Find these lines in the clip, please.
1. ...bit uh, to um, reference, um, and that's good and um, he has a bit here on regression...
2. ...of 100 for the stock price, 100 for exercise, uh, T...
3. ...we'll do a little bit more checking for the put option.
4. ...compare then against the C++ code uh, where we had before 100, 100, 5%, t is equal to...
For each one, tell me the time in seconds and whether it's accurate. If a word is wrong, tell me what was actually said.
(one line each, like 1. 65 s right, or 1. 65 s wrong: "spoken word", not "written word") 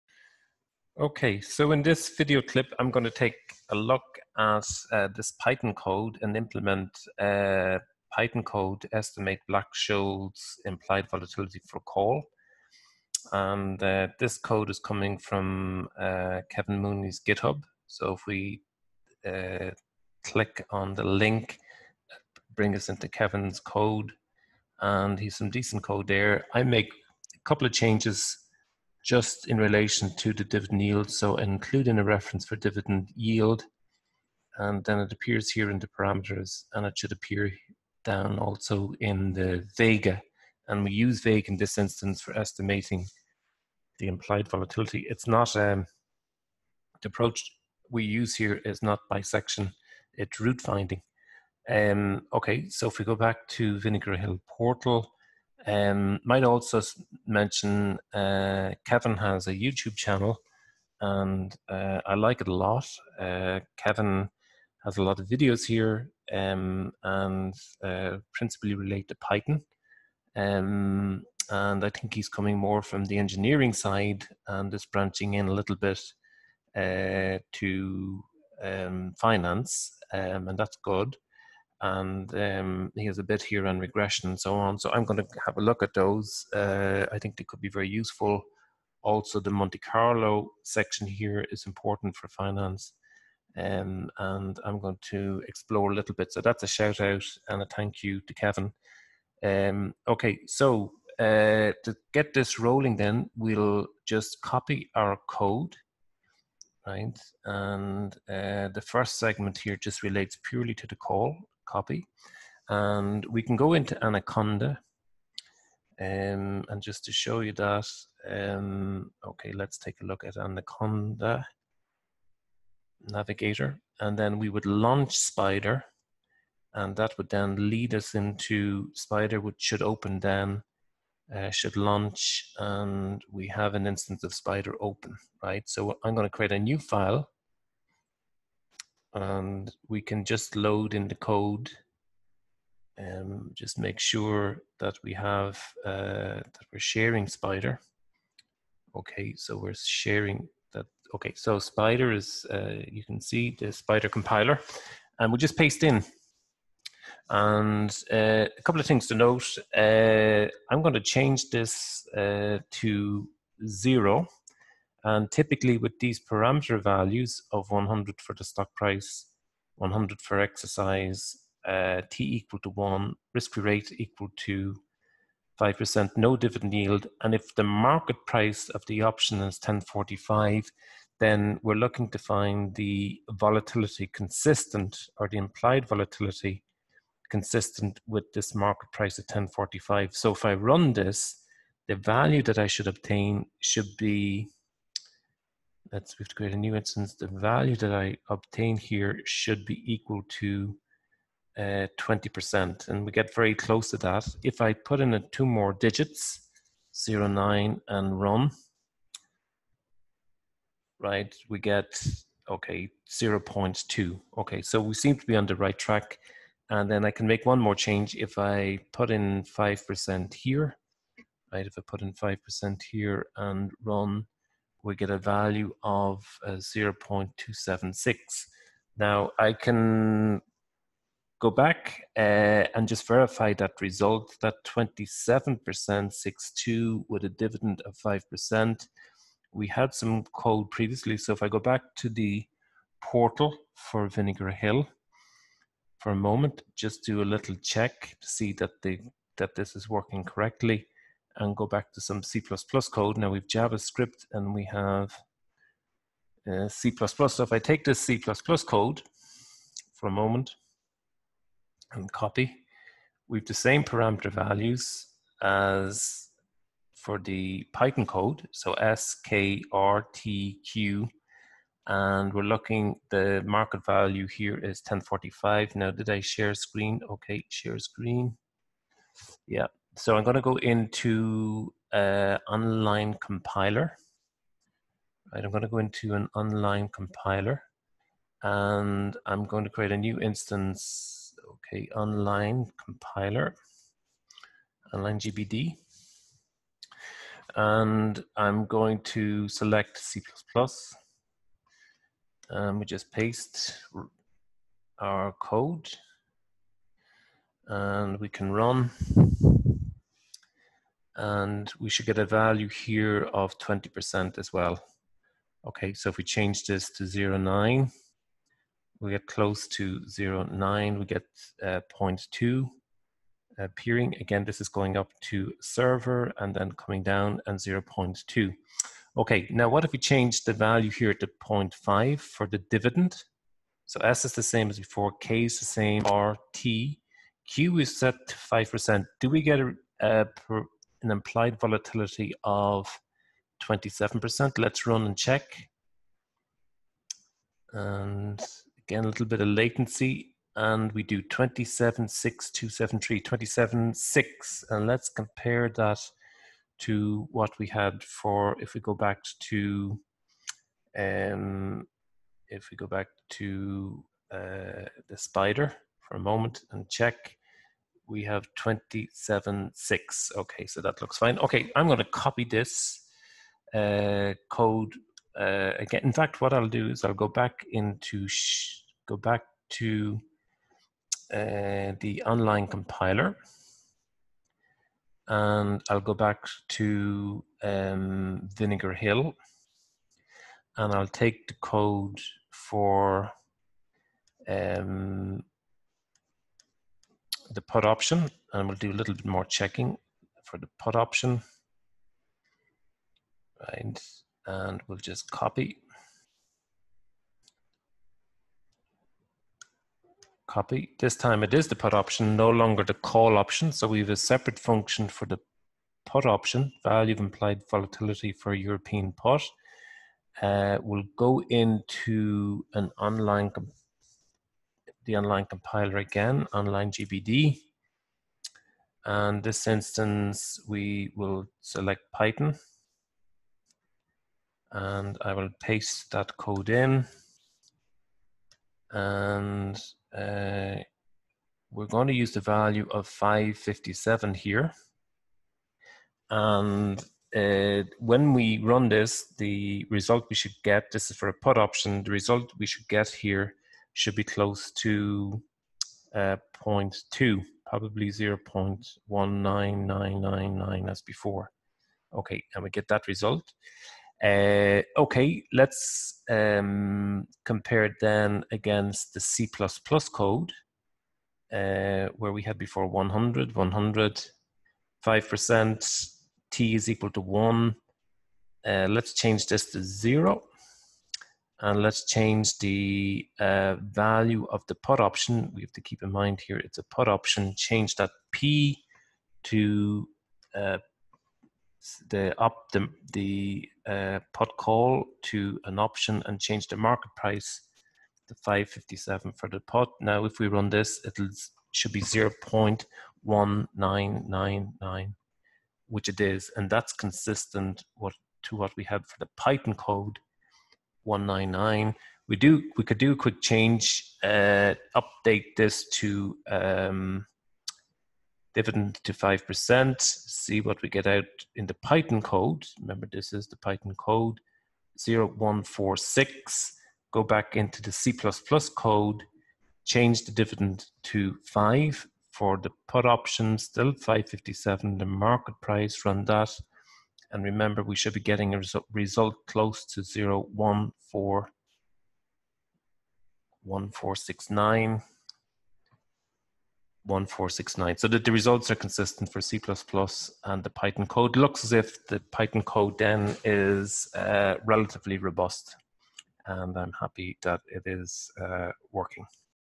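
1. 75 s wrong: "finance", not "reference"
2. 167 s right
3. 398 s right
4. 467 s right.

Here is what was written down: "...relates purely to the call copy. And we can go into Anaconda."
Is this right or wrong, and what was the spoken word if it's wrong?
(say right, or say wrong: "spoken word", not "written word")
right.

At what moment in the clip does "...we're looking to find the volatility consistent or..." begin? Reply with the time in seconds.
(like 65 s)
181 s.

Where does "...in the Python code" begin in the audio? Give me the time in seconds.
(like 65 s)
521 s.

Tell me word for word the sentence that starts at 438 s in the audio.
And uh, we're going to use the value of 557 here.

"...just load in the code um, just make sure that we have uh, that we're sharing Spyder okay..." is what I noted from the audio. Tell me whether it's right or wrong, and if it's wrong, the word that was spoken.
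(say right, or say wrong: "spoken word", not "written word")
right.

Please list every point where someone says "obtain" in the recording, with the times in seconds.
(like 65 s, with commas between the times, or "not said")
192 s, 198 s.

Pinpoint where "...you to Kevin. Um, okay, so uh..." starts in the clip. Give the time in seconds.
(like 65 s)
98 s.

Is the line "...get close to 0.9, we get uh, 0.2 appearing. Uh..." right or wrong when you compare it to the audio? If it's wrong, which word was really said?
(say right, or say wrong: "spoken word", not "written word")
right.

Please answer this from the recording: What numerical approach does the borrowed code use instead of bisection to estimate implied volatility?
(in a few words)
root finding.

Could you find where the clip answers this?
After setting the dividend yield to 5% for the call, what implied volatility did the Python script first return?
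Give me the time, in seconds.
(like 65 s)
226 s.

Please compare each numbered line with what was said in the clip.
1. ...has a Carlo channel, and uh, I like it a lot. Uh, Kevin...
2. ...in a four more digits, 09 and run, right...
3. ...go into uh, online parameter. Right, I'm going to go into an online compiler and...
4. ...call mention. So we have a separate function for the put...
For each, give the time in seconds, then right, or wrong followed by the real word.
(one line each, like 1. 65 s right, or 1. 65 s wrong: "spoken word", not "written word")
1. 59 s wrong: "YouTube", not "Carlo"
2. 205 s wrong: "two", not "four"
3. 280 s wrong: "compiler", not "parameter"
4. 412 s wrong: "option", not "mention".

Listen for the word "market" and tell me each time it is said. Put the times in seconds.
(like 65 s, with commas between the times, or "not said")
177 s, 188 s, 273 s, 496 s, 535 s.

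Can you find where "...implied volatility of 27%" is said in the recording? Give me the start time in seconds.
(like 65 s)
341 s.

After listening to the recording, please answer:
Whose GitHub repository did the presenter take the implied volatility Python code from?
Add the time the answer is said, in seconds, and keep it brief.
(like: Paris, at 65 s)
Kevin Mooney, at 16 s.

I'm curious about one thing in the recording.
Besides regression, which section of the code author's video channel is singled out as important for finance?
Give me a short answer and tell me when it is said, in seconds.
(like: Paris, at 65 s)
Monte Carlo, at 89 s.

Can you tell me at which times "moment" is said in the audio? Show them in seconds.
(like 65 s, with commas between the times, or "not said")
246 s, 260 s, 366 s.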